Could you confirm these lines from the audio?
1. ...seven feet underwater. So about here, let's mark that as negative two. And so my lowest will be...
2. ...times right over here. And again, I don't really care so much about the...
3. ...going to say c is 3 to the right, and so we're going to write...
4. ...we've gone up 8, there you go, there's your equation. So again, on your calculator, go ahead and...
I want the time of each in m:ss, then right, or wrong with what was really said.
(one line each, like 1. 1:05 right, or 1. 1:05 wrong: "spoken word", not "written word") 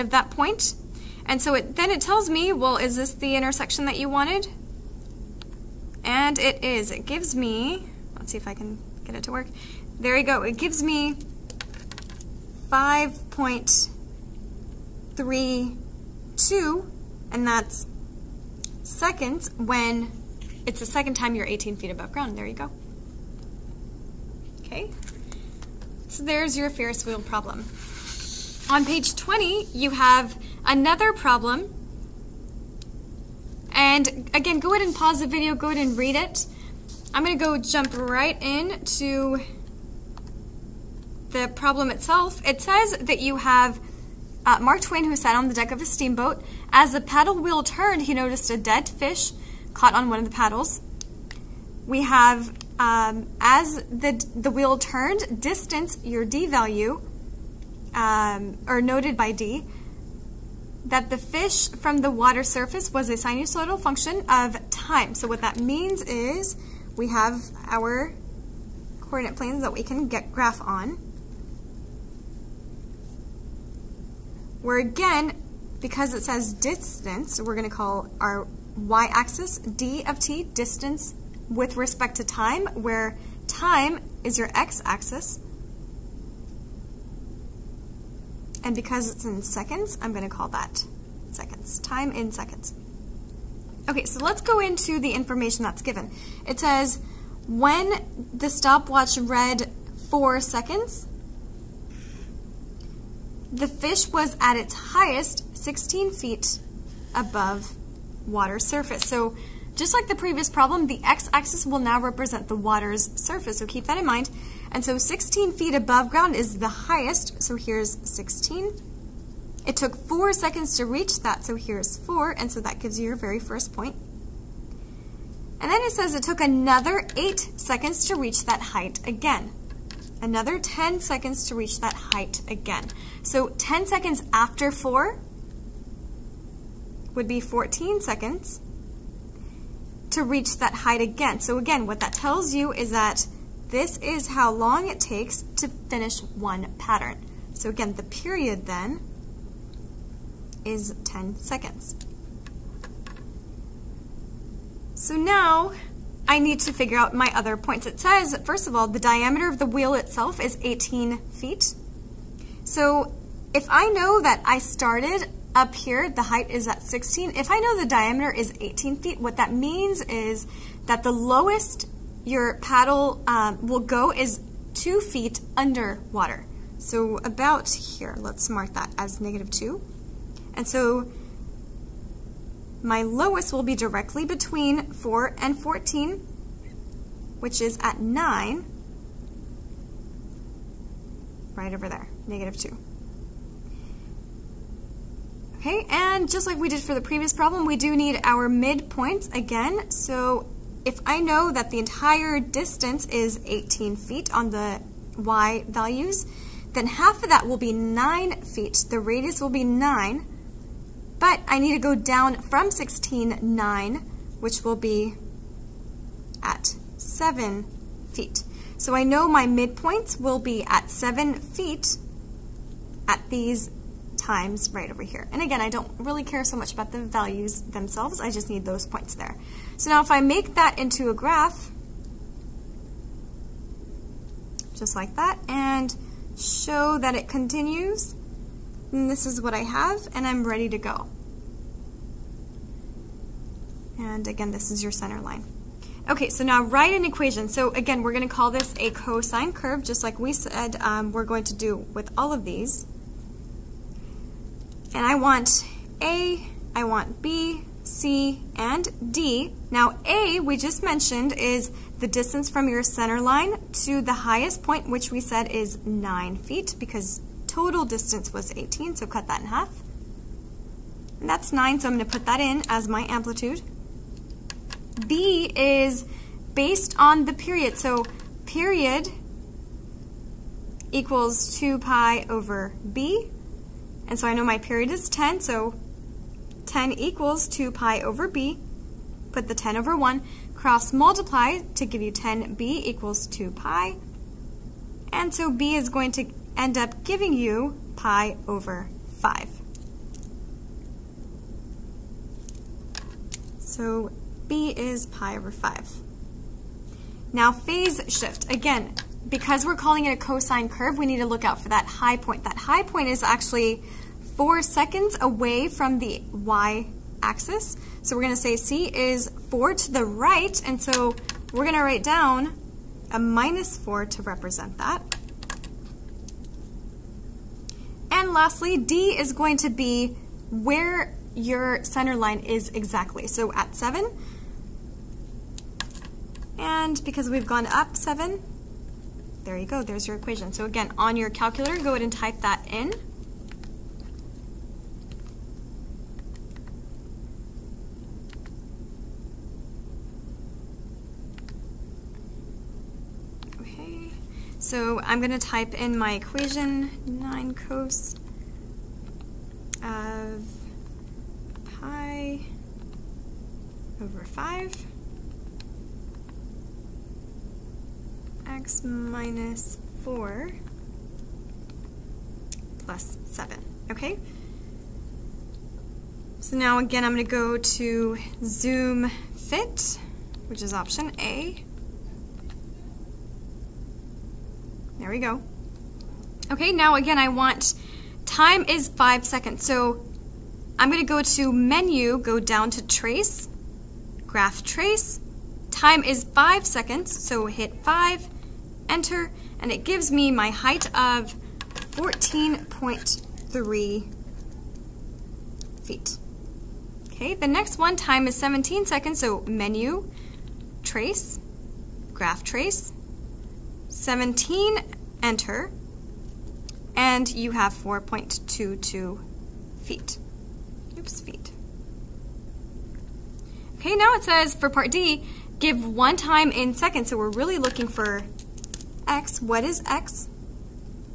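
1. 2:54 wrong: "two", not "seven"
2. 3:44 right
3. 5:18 wrong: "4", not "3"
4. 5:37 wrong: "7", not "8".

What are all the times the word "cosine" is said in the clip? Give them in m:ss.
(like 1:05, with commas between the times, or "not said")
4:08, 5:10.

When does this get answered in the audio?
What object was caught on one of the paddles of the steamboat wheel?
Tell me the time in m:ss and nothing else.
0:48.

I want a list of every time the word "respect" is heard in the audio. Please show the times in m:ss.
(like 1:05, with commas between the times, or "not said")
1:21.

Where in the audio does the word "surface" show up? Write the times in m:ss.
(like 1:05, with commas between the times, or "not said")
1:02, 1:48, 1:53.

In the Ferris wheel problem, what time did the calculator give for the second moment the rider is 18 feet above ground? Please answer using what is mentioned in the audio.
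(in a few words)
5.32.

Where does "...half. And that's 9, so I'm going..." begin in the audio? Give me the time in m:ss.
4:29.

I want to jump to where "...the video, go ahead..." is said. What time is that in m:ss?
0:35.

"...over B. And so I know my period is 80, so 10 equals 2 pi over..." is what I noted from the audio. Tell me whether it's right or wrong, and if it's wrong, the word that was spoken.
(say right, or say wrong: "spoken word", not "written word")
wrong: "10", not "80".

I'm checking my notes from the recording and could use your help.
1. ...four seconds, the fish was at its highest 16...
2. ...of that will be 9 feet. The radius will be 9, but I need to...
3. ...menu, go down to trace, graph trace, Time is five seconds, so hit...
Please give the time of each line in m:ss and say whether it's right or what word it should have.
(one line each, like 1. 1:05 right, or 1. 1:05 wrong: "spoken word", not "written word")
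1. 1:40 right
2. 3:27 right
3. 6:31 right.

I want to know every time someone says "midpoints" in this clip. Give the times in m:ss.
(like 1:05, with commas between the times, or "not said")
3:18, 3:39.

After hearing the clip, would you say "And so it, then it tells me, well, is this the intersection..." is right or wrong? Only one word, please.
right.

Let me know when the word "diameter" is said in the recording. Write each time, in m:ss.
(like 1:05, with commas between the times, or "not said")
2:38, 2:47.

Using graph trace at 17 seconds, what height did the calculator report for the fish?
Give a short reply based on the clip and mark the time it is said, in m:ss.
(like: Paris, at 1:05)
4.22 feet, at 6:57.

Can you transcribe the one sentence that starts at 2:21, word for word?
So again, what that tells you is that this is how long it takes to finish one pattern.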